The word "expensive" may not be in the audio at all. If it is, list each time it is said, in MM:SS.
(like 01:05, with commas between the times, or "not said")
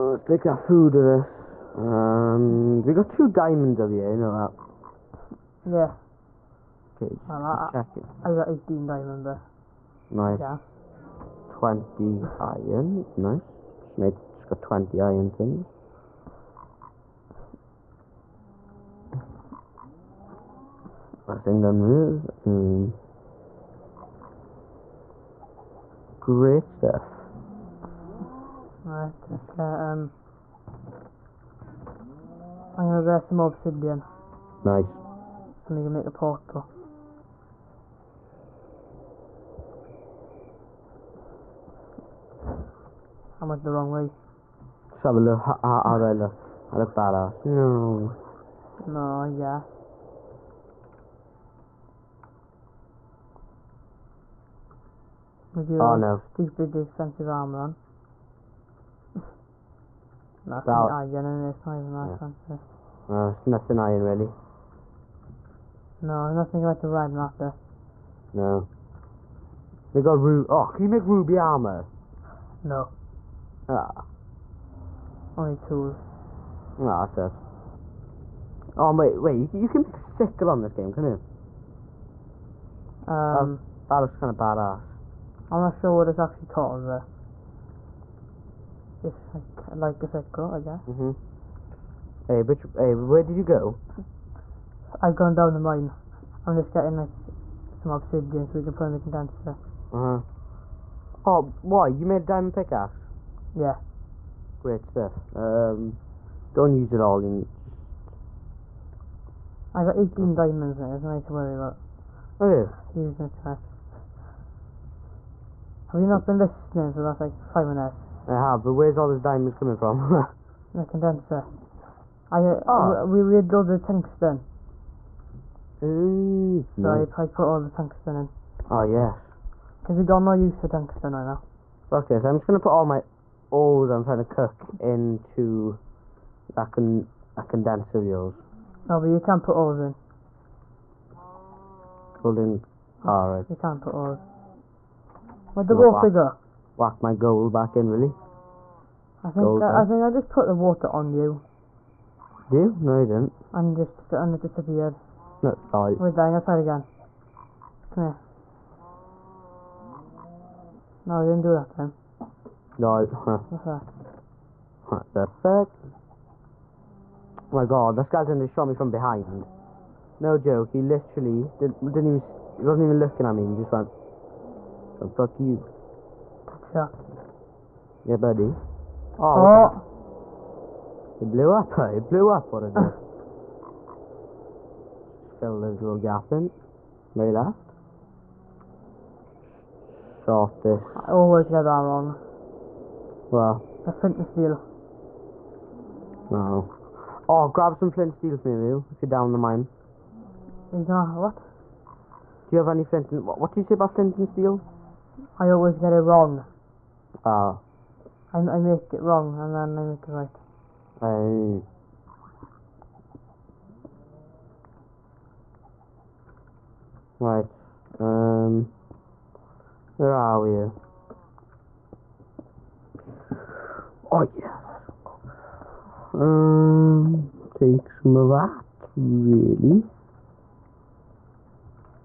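00:56, 01:02.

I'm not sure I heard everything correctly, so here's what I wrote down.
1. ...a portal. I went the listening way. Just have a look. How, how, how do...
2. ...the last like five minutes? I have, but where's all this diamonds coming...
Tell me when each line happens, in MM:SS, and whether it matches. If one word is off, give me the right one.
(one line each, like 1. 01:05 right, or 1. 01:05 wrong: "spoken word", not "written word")
1. 00:36 wrong: "wrong", not "listening"
2. 01:56 right.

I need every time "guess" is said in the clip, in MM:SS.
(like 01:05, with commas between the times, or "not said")
00:49, 01:30.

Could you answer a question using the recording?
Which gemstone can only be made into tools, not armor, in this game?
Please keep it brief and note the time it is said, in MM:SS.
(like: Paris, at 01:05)
ruby, at 01:11.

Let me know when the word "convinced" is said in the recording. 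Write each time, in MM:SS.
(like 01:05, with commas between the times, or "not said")
not said.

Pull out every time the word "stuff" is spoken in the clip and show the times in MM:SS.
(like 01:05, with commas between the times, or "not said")
00:26, 01:44.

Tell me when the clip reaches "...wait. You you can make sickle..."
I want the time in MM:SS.
01:19.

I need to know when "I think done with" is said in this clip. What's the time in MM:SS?
00:21.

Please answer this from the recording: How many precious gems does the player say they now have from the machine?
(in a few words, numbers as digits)
18.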